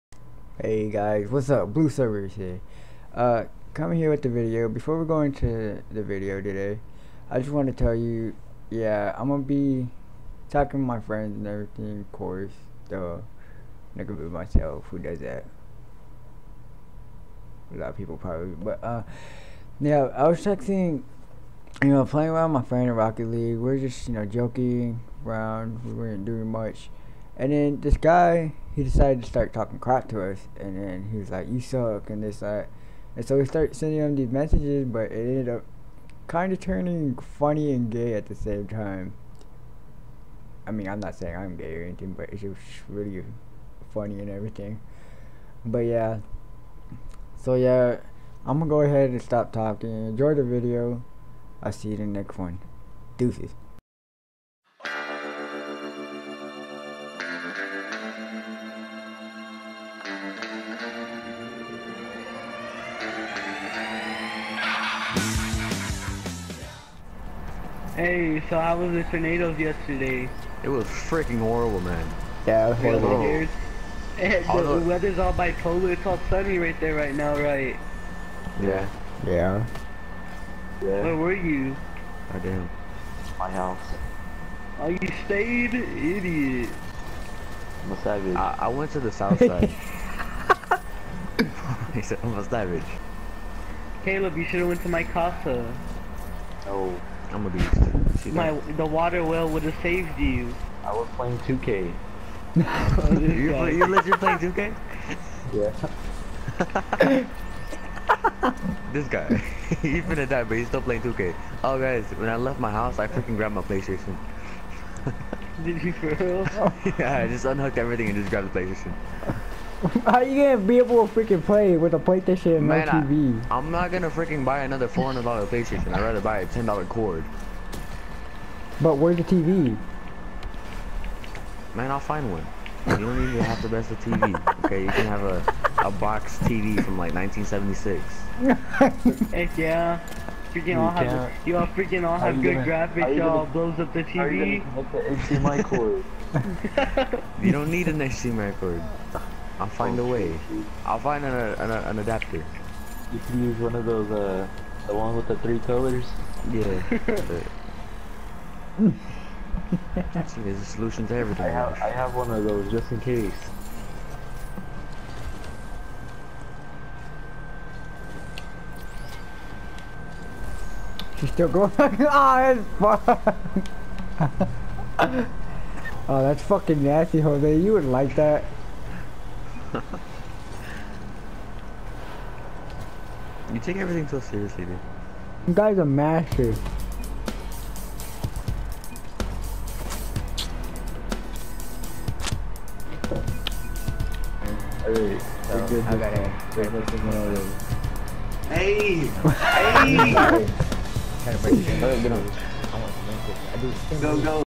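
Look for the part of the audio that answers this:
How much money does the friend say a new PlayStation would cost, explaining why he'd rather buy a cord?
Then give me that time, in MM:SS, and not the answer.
02:04.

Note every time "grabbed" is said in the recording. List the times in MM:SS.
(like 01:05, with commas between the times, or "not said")
01:53, 01:58.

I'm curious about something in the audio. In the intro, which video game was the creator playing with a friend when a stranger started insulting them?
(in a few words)
Rocket League.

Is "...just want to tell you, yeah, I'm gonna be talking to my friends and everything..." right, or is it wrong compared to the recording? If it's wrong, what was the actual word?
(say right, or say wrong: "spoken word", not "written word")
right.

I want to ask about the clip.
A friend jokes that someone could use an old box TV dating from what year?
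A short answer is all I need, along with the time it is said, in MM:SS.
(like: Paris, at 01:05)
1976, at 02:17.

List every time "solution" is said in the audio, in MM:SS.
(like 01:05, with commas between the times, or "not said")
02:40.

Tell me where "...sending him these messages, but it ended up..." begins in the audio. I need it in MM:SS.
00:33.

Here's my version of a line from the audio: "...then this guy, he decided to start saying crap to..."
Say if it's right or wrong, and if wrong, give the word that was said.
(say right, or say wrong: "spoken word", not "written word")
wrong: "talking", not "saying".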